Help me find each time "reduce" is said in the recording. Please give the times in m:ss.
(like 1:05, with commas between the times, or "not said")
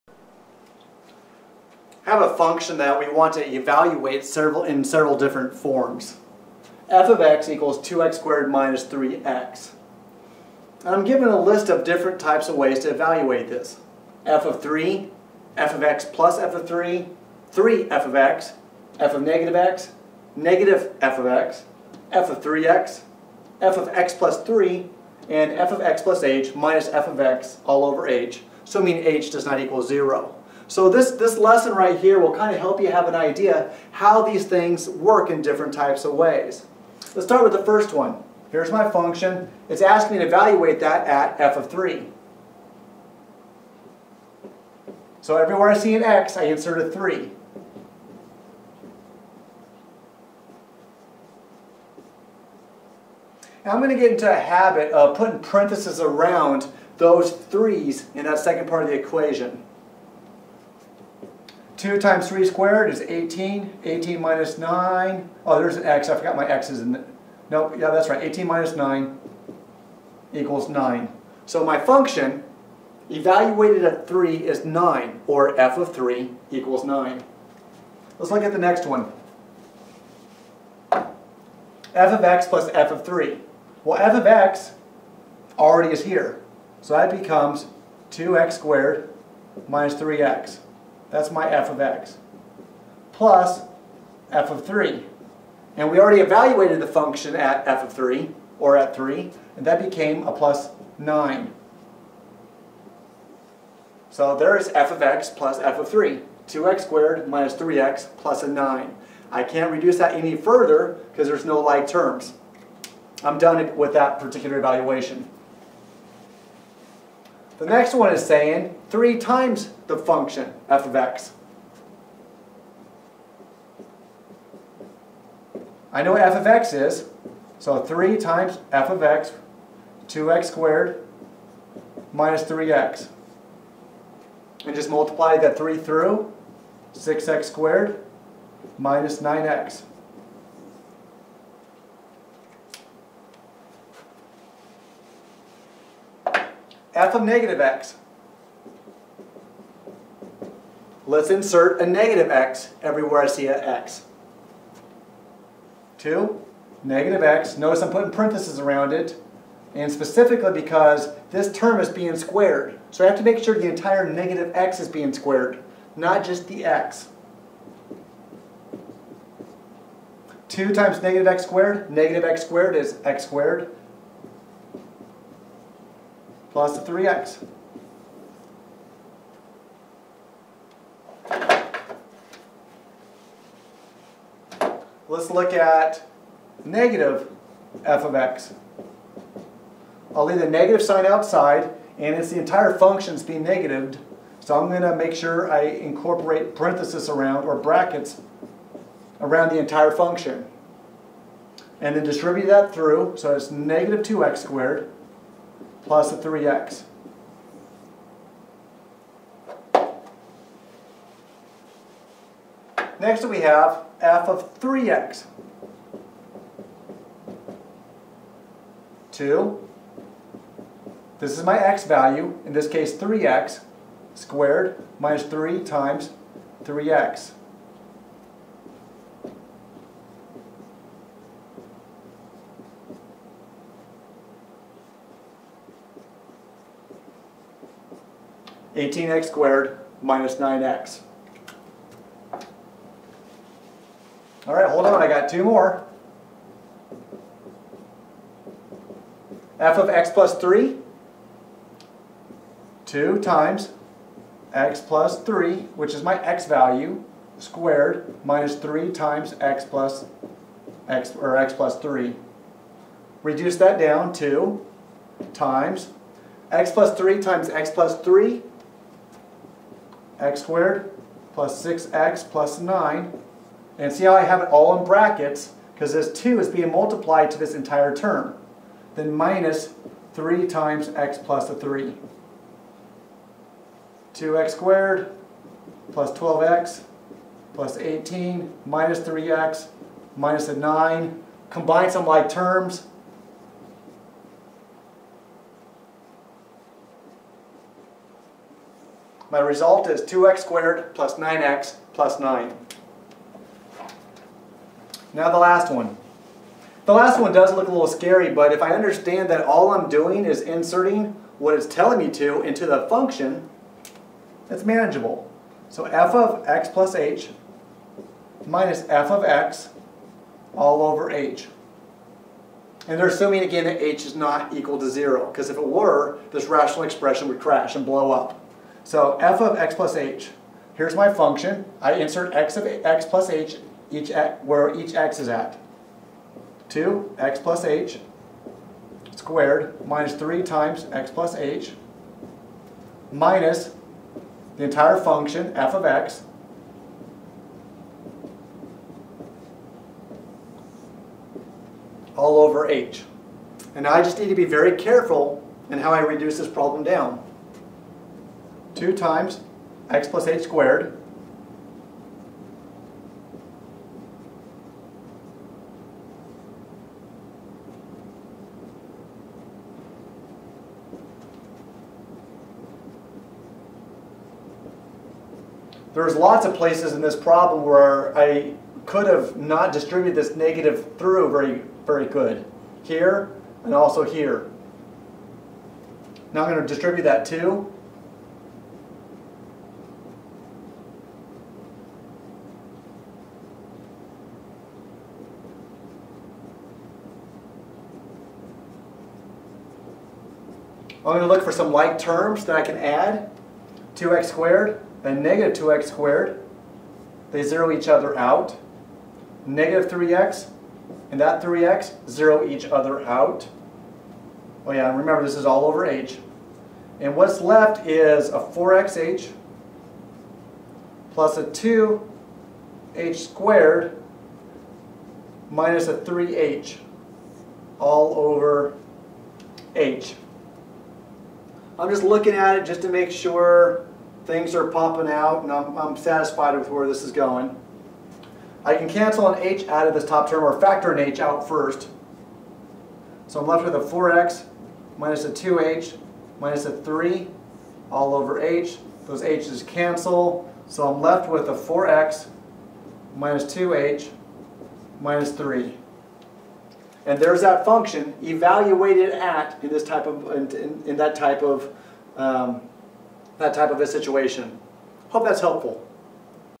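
1:49, 4:23, 5:55.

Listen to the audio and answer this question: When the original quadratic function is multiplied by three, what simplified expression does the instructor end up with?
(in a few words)
6x² − 9x.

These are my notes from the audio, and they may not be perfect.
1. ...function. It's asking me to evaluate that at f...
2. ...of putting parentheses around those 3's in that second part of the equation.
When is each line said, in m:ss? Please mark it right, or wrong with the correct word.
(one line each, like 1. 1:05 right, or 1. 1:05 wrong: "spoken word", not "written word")
1. 0:38 right
2. 0:54 right.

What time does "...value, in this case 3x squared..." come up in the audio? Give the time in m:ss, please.
3:41.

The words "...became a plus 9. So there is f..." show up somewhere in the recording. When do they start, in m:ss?
1:39.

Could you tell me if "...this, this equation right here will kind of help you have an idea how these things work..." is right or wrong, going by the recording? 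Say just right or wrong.
wrong.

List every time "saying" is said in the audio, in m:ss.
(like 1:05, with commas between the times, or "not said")
1:58.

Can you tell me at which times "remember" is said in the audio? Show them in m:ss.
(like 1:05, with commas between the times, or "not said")
6:54.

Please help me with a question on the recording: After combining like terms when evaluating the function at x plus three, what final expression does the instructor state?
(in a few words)
2x² + 9x + 9.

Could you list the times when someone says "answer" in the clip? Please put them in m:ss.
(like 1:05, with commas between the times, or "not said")
not said.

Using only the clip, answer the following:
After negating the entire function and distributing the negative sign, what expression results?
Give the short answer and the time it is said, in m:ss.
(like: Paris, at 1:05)
−2x² + 3x, at 3:23.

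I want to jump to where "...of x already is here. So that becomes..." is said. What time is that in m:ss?
1:24.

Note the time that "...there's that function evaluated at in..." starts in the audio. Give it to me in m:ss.
7:37.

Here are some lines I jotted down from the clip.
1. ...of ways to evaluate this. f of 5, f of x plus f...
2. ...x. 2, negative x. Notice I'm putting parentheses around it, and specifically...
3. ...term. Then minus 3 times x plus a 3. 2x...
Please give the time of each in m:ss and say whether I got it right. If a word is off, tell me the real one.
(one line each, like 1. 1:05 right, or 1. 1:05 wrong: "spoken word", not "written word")
1. 0:12 wrong: "3", not "5"
2. 2:33 right
3. 4:37 right.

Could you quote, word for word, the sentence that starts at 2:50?
2 times negative x squared, negative x squared is x squared.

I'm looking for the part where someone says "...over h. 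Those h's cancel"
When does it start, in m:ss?
7:28.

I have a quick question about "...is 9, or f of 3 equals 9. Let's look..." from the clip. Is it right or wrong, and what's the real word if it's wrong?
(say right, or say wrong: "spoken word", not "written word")
right.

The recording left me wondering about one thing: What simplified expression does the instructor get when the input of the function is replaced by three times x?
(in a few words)
18x² − 9x.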